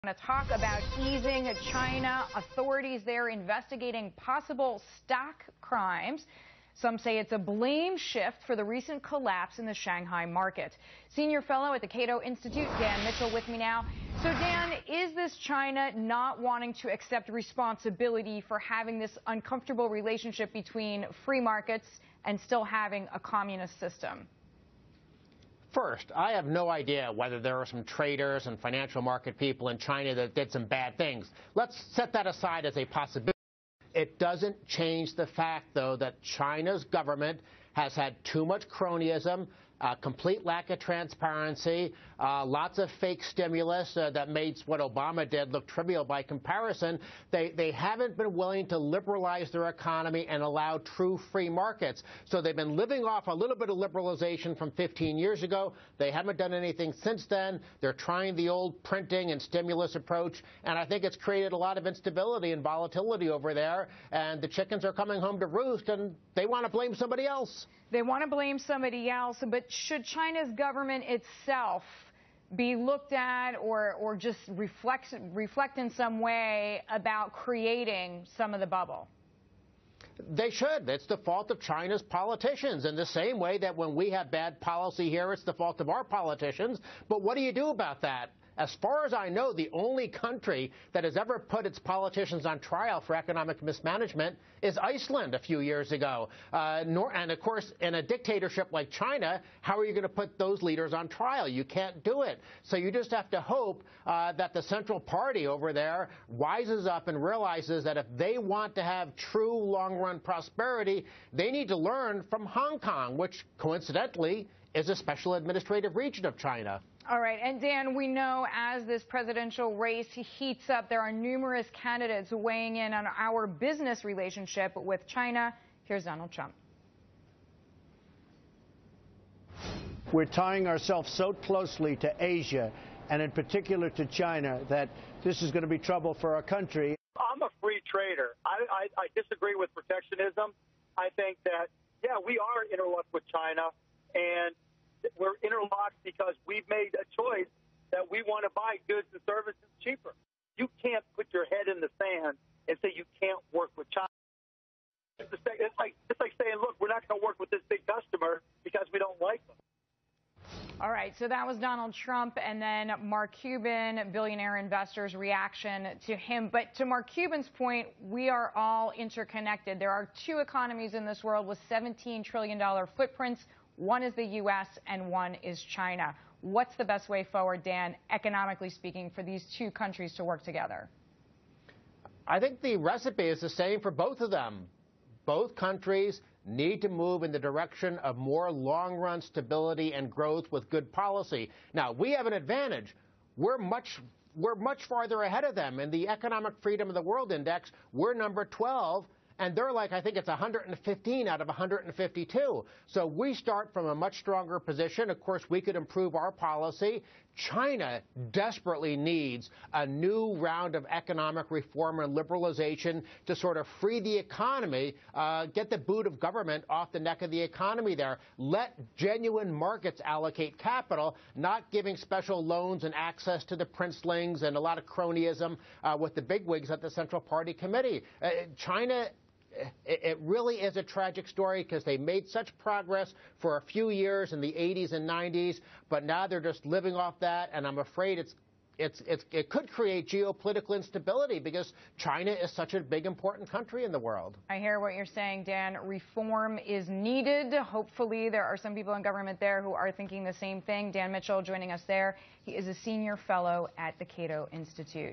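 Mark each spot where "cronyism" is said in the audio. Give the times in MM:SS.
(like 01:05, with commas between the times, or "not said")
00:38, 03:44.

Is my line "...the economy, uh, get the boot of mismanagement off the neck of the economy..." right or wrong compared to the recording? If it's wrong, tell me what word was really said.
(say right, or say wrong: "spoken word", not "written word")
wrong: "government", not "mismanagement".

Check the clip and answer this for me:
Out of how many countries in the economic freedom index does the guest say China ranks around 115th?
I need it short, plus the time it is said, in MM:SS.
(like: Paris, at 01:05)
152, at 03:21.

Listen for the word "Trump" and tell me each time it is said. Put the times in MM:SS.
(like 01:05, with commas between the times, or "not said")
02:06, 02:41.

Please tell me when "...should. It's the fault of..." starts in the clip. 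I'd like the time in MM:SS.
01:20.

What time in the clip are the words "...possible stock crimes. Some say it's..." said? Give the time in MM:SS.
00:04.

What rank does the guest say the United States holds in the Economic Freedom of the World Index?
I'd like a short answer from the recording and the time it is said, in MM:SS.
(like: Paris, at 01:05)
12, at 03:18.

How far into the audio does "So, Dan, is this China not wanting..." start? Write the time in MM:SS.
00:14.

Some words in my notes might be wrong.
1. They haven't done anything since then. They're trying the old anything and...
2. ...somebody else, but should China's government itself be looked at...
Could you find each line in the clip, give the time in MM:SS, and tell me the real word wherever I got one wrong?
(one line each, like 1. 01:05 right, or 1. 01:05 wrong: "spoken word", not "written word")
1. 00:55 wrong: "printing", not "anything"
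2. 01:08 right.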